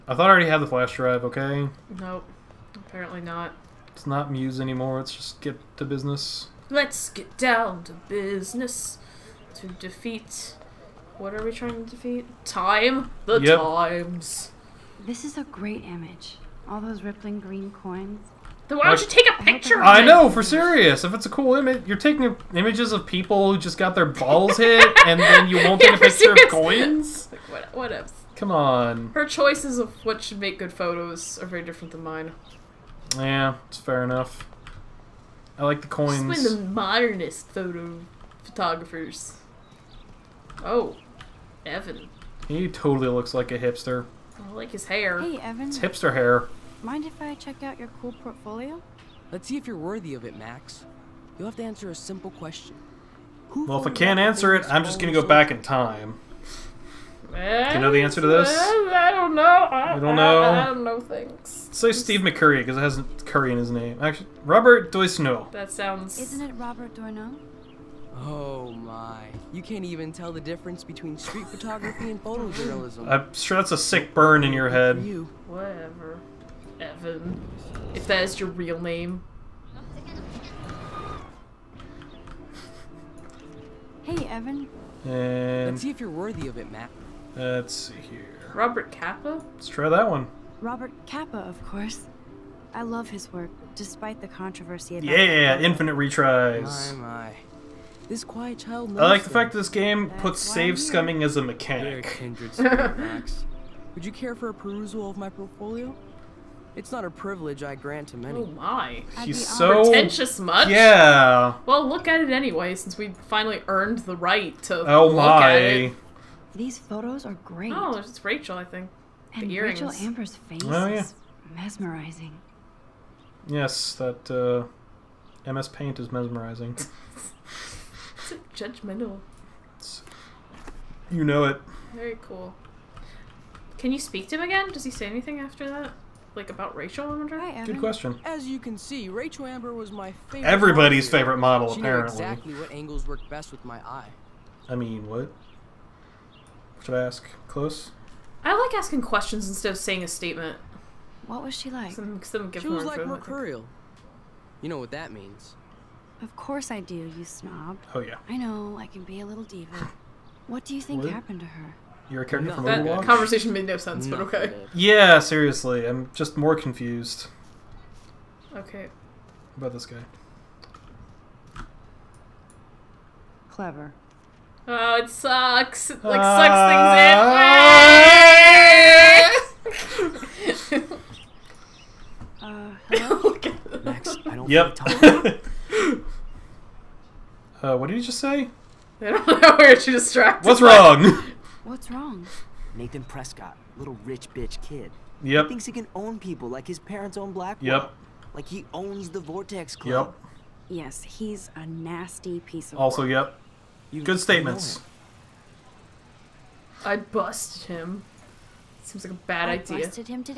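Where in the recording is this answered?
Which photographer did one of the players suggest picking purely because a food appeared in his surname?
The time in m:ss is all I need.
1:01.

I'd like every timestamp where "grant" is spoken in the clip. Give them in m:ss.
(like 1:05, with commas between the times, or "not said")
1:47.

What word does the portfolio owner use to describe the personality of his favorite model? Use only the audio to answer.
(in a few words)
mercurial.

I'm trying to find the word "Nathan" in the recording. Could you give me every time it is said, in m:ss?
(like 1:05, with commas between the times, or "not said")
3:12.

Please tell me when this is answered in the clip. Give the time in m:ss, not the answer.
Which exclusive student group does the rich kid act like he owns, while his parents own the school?
3:19.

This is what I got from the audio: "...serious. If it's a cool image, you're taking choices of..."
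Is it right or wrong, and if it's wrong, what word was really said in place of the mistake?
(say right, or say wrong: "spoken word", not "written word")
wrong: "images", not "choices".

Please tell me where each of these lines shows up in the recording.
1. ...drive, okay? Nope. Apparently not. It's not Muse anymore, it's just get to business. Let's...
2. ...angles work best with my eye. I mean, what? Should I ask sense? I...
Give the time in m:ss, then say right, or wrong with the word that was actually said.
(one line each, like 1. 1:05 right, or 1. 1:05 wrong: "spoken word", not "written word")
1. 0:00 right
2. 2:22 wrong: "close", not "sense".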